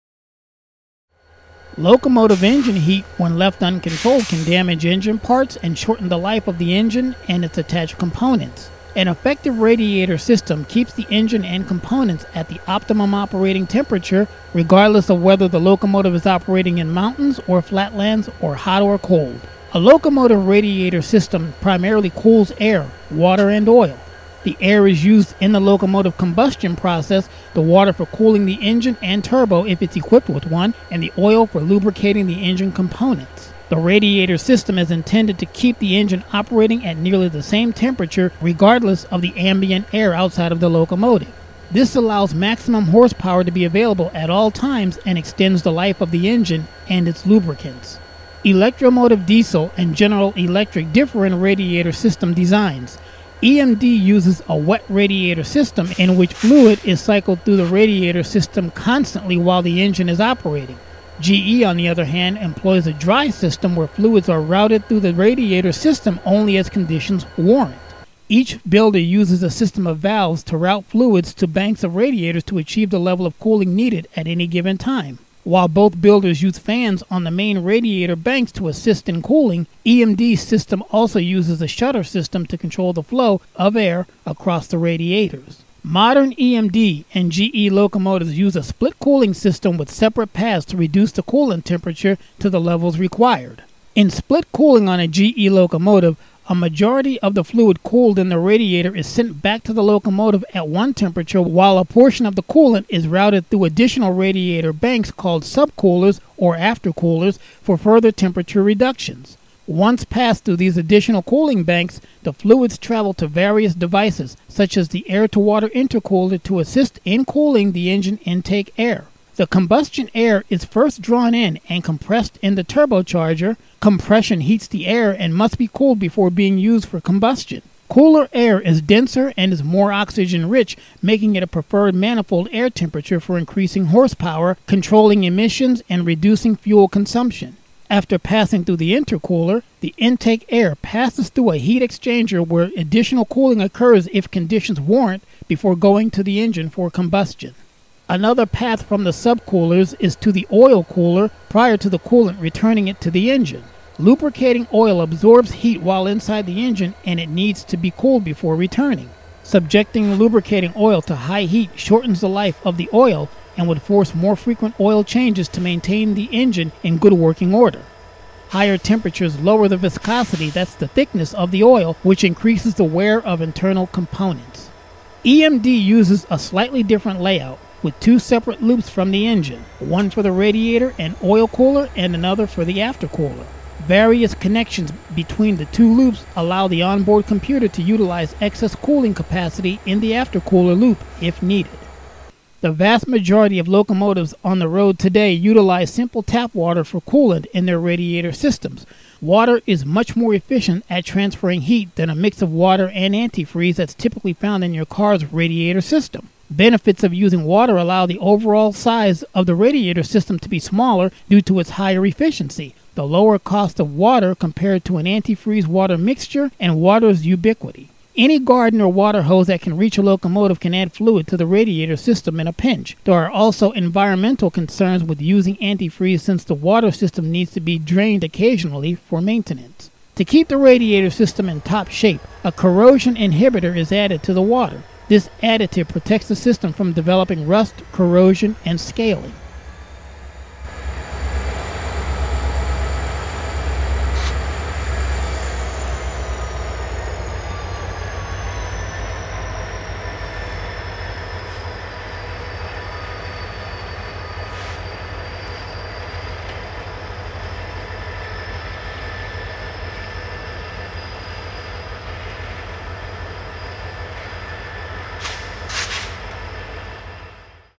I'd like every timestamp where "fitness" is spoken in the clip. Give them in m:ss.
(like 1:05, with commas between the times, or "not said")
not said.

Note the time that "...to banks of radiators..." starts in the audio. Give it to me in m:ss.
1:11.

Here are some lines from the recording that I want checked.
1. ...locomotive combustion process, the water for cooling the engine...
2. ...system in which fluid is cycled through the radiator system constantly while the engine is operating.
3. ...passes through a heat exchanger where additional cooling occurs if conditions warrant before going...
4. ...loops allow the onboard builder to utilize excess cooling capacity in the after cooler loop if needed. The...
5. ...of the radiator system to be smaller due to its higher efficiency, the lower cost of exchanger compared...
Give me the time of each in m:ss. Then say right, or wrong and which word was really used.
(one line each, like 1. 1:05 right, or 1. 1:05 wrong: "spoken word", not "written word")
1. 0:25 right
2. 0:55 right
3. 2:20 right
4. 3:05 wrong: "computer", not "builder"
5. 3:29 wrong: "water", not "exchanger".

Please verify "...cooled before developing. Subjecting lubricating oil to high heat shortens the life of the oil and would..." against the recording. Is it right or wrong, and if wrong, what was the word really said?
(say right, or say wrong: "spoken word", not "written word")
wrong: "returning", not "developing".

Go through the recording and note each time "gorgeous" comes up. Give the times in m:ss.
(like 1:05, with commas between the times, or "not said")
not said.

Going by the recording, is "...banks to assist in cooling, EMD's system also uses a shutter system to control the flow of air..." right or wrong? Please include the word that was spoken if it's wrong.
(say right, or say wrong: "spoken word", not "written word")
right.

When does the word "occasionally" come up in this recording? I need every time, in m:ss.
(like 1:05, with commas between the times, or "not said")
3:48.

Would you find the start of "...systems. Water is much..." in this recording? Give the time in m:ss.
3:18.